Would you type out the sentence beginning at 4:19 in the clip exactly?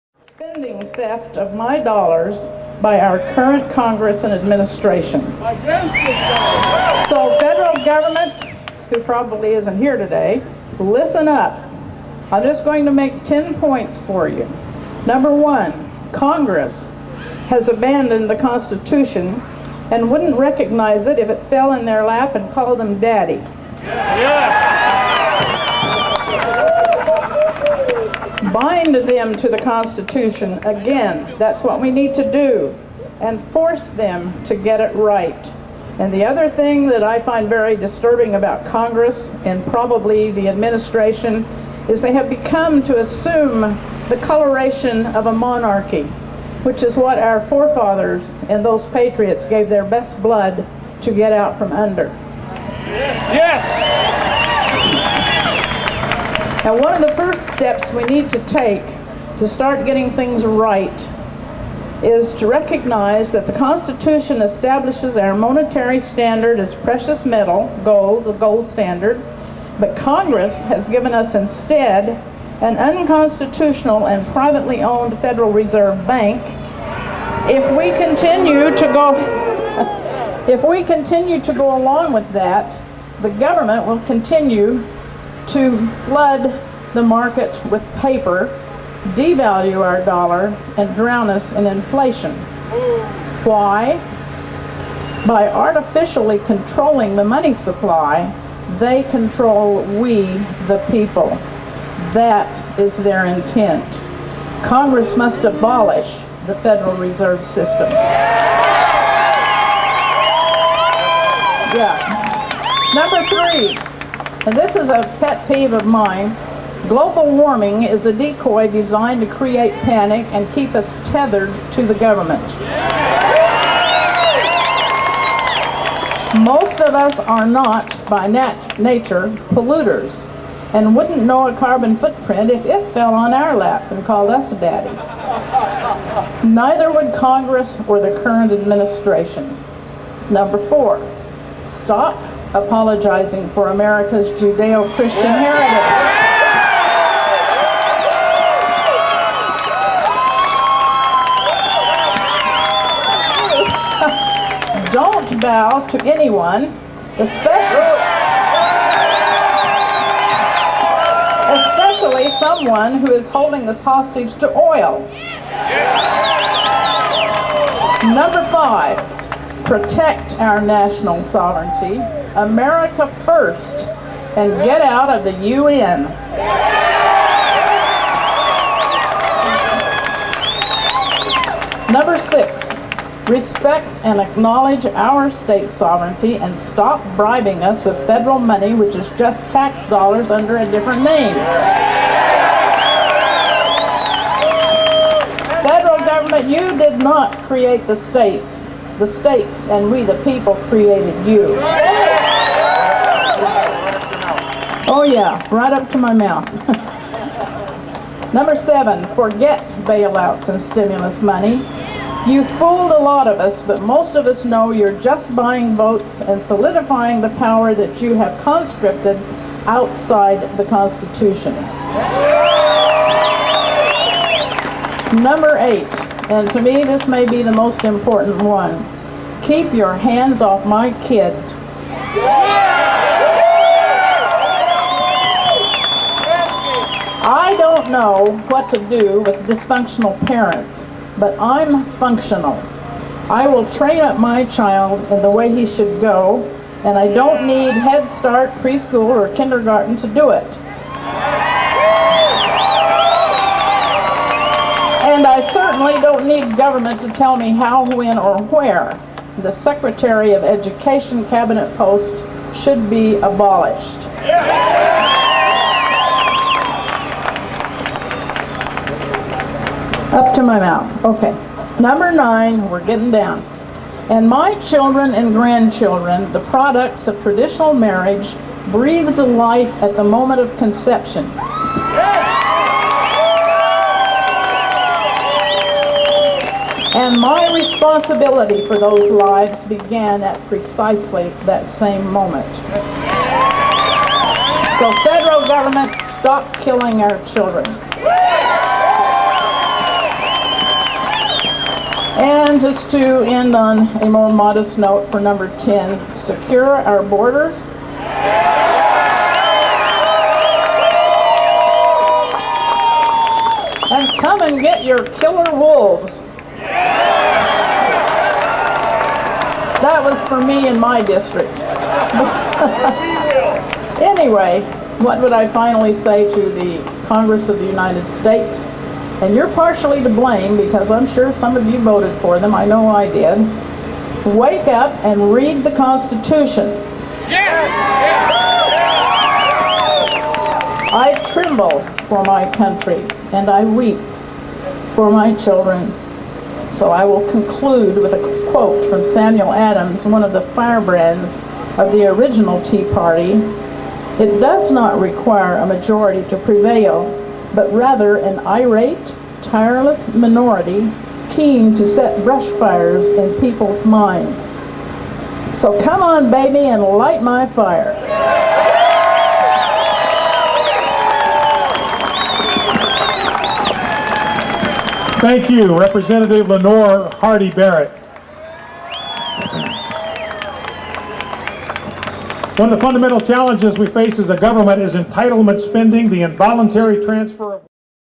The Secretary of Education cabinet post should be abolished.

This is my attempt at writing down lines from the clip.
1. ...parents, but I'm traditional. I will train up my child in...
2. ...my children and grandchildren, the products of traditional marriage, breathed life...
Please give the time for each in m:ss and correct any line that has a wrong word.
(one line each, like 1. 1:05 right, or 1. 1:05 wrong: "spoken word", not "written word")
1. 4:00 wrong: "functional", not "traditional"
2. 4:34 right.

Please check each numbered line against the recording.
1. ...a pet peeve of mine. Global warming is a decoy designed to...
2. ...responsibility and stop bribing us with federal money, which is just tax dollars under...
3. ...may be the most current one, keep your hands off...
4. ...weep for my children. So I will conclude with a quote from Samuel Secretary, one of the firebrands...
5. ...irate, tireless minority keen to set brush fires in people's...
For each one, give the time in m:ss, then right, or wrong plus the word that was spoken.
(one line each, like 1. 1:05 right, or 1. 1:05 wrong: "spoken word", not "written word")
1. 1:54 right
2. 3:05 wrong: "sovereignty", not "responsibility"
3. 3:47 wrong: "important", not "current"
4. 5:43 wrong: "Adams", not "Secretary"
5. 5:58 right.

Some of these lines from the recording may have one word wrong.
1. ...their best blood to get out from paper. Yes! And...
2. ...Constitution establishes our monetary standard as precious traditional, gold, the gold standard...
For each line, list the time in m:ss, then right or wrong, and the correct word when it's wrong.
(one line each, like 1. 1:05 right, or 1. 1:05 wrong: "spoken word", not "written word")
1. 0:49 wrong: "under", not "paper"
2. 1:03 wrong: "metal", not "traditional".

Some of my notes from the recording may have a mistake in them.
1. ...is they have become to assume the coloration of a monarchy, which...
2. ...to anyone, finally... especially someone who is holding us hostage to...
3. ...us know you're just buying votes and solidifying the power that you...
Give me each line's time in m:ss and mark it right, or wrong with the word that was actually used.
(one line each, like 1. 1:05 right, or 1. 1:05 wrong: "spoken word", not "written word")
1. 0:41 right
2. 2:35 wrong: "especially", not "finally"
3. 3:34 right.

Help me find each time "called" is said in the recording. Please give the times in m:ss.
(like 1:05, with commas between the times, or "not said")
0:22, 2:14.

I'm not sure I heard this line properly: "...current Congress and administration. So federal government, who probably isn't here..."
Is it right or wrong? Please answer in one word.
right.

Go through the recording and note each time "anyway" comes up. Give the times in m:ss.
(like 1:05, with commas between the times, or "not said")
5:24.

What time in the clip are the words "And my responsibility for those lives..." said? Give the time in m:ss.
4:46.